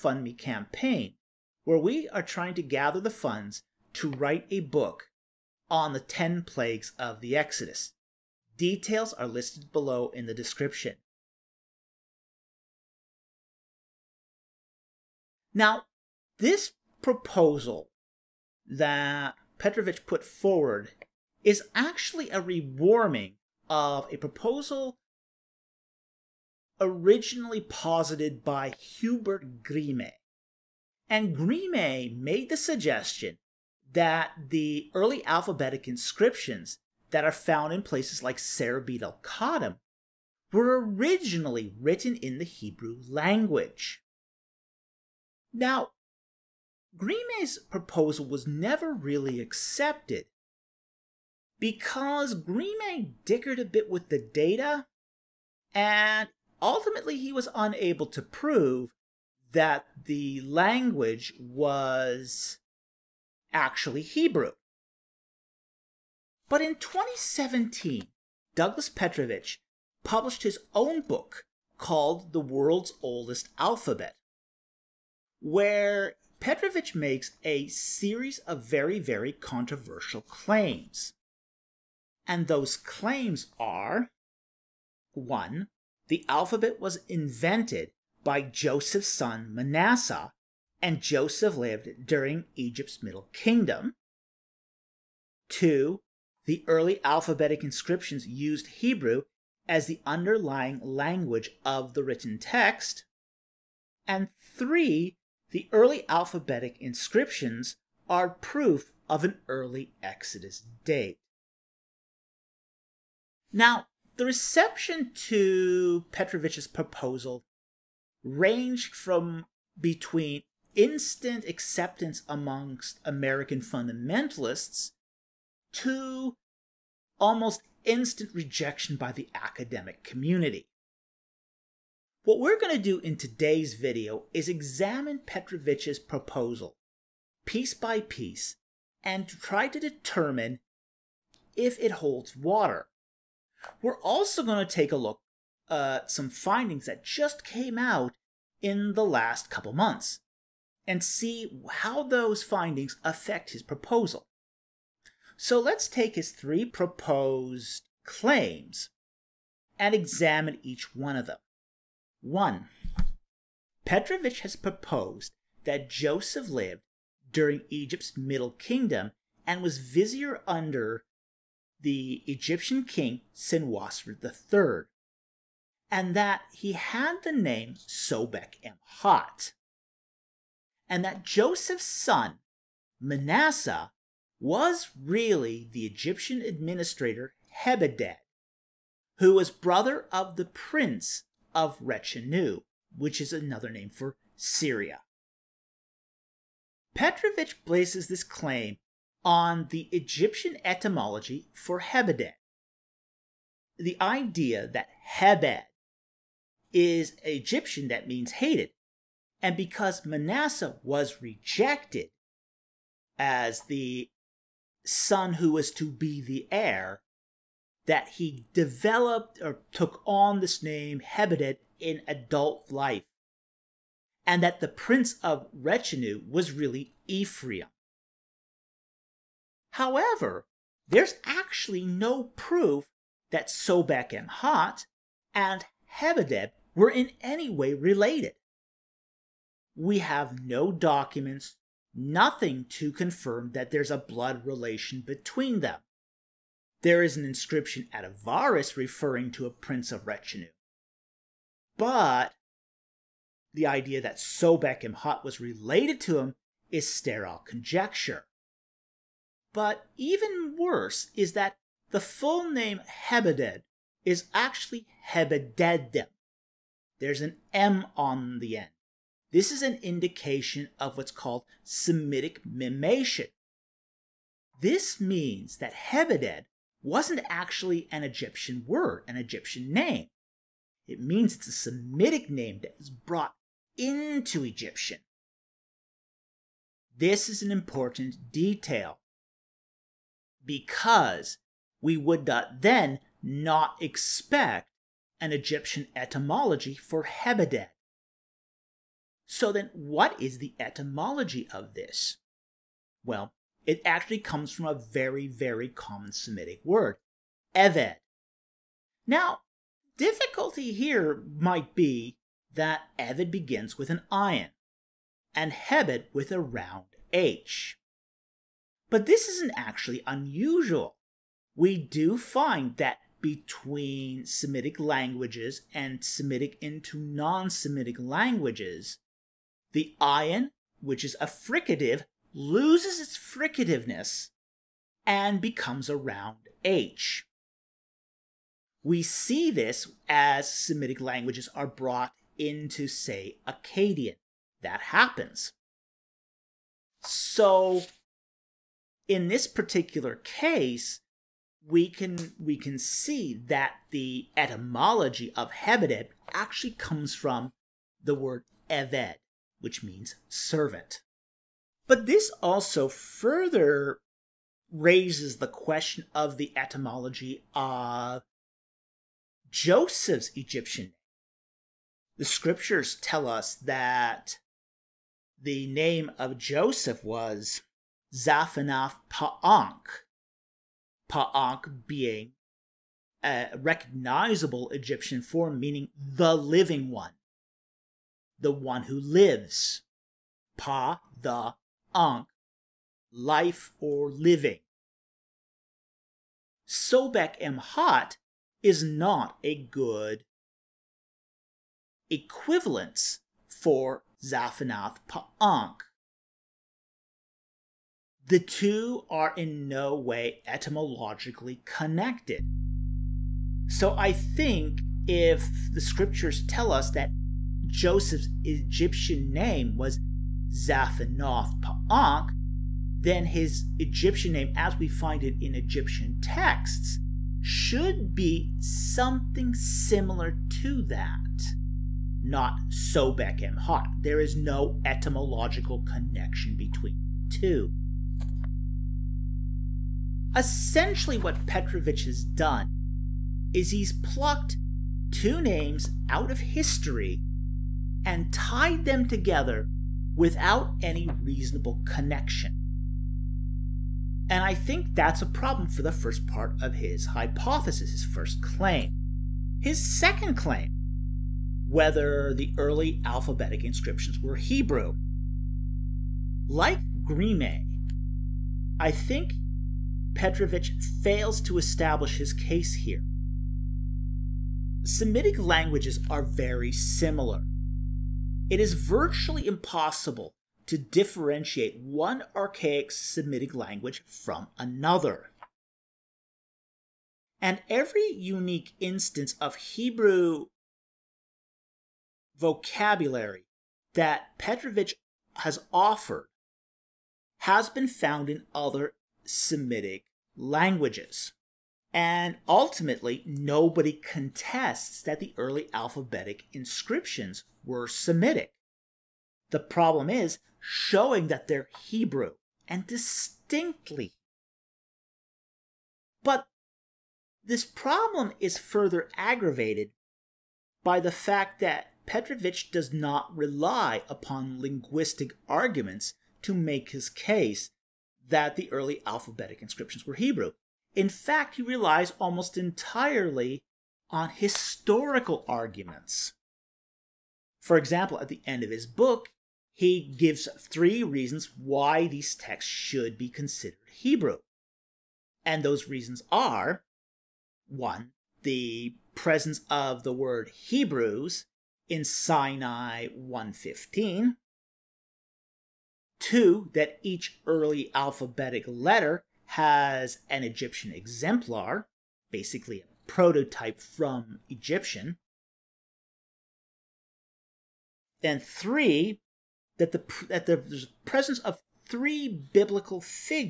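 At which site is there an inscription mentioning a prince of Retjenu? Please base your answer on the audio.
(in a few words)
Avaris.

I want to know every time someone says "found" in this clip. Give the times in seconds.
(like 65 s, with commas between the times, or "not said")
37 s, 497 s.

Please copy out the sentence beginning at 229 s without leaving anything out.
However, there's actually no proof that Sobekemhat and Hebeded were in any way related.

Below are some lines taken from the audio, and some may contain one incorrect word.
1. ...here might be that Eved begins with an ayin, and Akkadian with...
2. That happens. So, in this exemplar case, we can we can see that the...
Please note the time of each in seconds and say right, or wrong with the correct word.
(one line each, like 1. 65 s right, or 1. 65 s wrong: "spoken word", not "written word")
1. 310 s wrong: "Hebed", not "Akkadian"
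2. 344 s wrong: "particular", not "exemplar".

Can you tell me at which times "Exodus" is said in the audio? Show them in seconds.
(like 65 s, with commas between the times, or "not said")
7 s, 110 s.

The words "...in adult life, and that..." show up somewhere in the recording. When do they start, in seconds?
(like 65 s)
221 s.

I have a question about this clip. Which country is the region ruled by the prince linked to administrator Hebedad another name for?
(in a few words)
Syria.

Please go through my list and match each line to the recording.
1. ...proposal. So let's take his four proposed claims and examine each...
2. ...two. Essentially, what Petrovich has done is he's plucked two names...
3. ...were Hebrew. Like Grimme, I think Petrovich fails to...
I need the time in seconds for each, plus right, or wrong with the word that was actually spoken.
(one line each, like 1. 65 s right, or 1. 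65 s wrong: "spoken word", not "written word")
1. 153 s wrong: "three", not "four"
2. 437 s right
3. 464 s right.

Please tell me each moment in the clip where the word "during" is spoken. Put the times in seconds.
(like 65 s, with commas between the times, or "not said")
92 s, 167 s.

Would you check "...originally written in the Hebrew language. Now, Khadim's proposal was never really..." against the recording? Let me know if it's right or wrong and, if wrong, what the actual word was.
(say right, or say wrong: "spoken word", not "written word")
wrong: "Grimme", not "Khadim".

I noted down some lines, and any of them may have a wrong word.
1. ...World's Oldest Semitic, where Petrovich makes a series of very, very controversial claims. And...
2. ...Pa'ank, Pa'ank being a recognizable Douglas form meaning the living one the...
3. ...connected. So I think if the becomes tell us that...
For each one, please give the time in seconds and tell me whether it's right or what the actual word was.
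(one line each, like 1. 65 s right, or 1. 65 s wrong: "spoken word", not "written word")
1. 72 s wrong: "Alphabet", not "Semitic"
2. 379 s wrong: "Egyptian", not "Douglas"
3. 411 s wrong: "scriptures", not "becomes".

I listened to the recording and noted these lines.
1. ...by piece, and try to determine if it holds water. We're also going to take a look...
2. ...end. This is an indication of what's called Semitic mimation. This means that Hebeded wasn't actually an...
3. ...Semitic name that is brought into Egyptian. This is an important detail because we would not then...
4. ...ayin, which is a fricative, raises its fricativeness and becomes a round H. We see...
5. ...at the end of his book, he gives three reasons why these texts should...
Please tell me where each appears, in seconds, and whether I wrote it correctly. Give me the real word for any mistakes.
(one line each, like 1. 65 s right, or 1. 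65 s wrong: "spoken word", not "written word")
1. 137 s right
2. 268 s right
3. 281 s right
4. 330 s wrong: "loses", not "raises"
5. 538 s right.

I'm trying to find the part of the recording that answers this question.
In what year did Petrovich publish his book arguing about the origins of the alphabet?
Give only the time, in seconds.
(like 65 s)
66 s.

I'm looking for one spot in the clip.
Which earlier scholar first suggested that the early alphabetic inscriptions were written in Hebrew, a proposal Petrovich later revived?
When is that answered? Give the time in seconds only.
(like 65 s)
28 s.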